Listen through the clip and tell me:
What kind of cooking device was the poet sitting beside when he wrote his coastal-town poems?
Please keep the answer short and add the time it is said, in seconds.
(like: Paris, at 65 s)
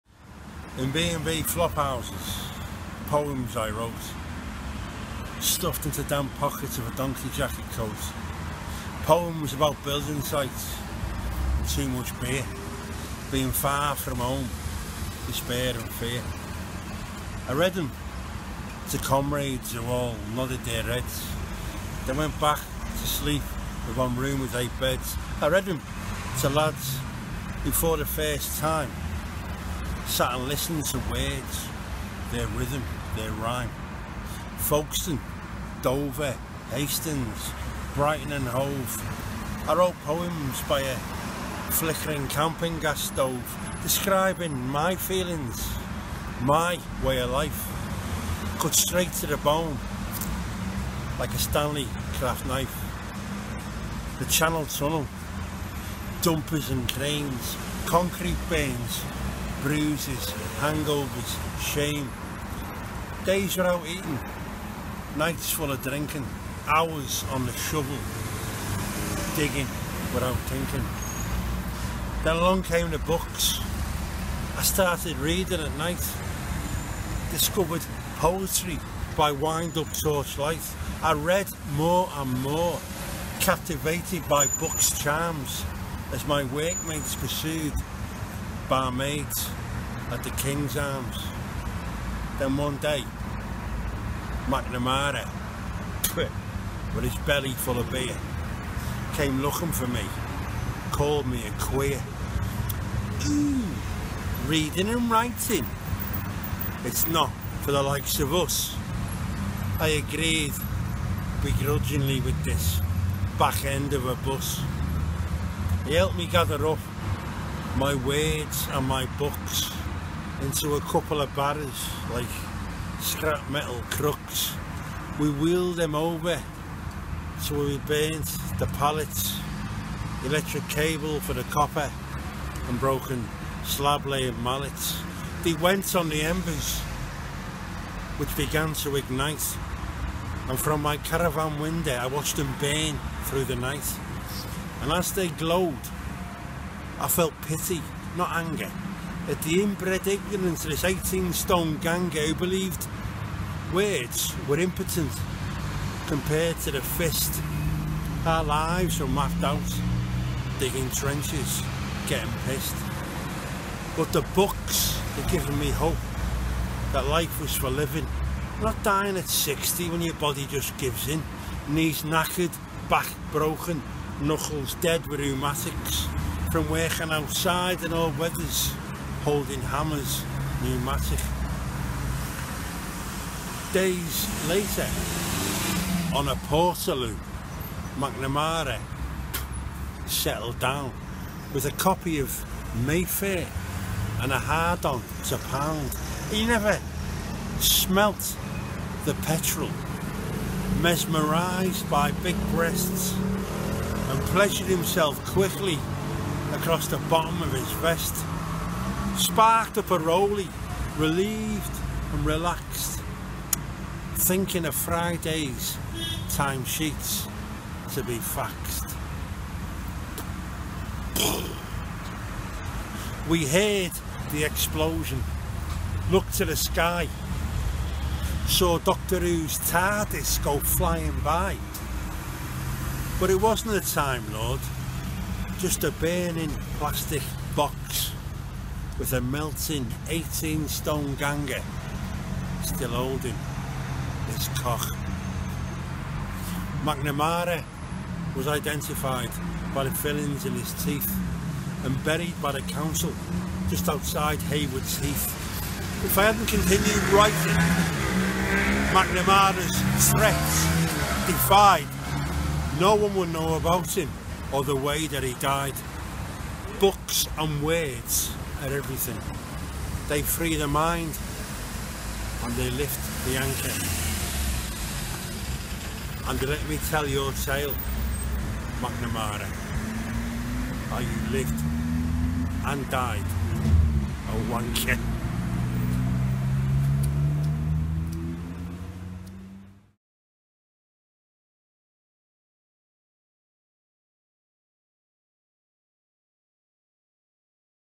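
camping gas stove, at 42 s.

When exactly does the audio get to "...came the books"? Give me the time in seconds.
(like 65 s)
72 s.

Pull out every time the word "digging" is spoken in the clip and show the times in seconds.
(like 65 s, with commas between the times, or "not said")
69 s, 160 s.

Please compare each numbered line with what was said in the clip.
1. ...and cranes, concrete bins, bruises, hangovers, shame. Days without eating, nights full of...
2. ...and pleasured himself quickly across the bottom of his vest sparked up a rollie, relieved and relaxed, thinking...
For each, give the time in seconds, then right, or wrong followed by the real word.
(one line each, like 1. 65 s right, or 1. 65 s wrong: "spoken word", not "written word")
1. 56 s right
2. 204 s right.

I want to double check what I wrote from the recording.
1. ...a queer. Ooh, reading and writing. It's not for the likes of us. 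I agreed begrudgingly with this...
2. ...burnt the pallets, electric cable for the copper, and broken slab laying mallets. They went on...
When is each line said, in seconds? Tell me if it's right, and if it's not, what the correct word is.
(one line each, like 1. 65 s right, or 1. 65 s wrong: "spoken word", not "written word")
1. 101 s right
2. 127 s right.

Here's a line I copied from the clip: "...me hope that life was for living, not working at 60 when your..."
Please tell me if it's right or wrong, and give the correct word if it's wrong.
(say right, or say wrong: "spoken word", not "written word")
wrong: "dying", not "working".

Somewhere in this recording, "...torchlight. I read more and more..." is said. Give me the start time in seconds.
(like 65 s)
80 s.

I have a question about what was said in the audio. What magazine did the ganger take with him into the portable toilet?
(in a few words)
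Mayfair.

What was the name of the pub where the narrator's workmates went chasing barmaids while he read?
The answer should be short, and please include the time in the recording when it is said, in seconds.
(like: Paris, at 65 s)
King's Arms, at 90 s.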